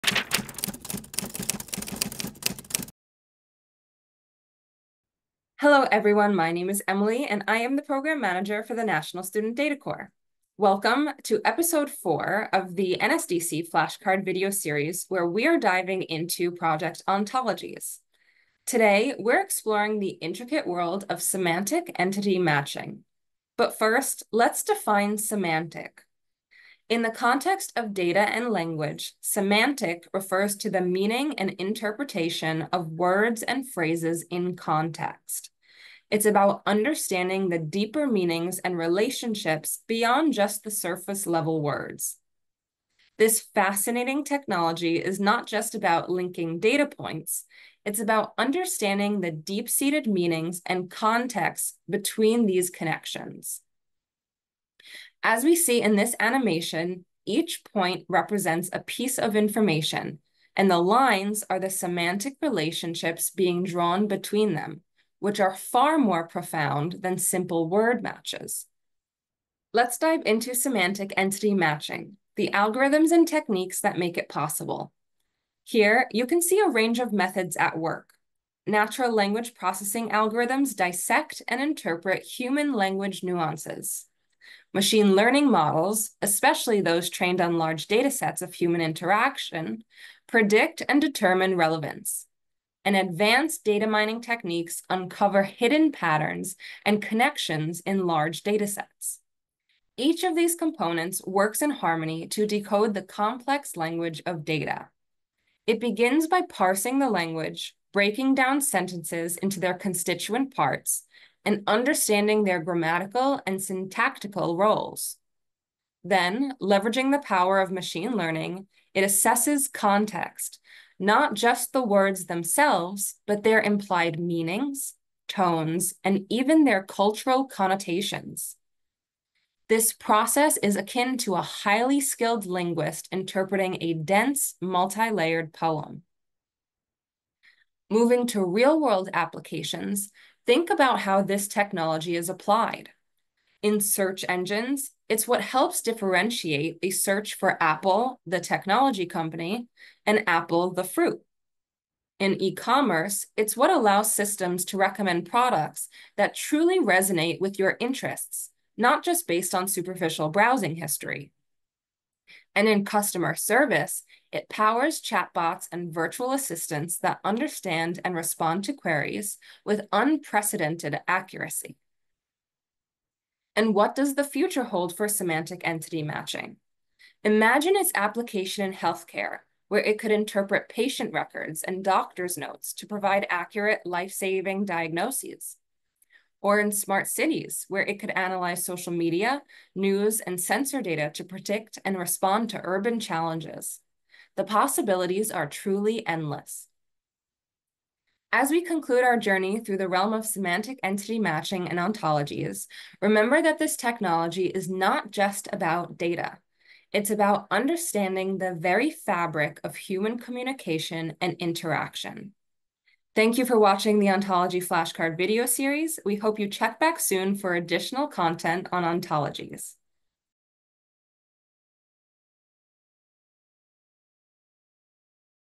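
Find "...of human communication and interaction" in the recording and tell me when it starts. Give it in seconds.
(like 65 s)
209 s.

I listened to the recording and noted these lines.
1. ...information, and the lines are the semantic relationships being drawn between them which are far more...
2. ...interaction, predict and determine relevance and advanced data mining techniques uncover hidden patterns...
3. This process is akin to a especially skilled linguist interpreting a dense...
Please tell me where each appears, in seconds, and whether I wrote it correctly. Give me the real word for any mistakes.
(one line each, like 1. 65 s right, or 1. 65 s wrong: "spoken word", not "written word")
1. 59 s right
2. 88 s right
3. 129 s wrong: "highly", not "especially".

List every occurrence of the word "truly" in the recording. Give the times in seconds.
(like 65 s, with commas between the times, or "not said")
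156 s, 195 s.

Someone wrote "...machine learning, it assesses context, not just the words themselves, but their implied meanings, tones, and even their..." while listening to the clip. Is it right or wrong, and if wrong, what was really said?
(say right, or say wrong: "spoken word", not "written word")
right.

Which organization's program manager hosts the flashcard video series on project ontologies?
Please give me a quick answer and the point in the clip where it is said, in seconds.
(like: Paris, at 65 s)
National Student Data Corps, at 8 s.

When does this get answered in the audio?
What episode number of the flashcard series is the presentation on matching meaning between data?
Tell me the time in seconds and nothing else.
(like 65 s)
11 s.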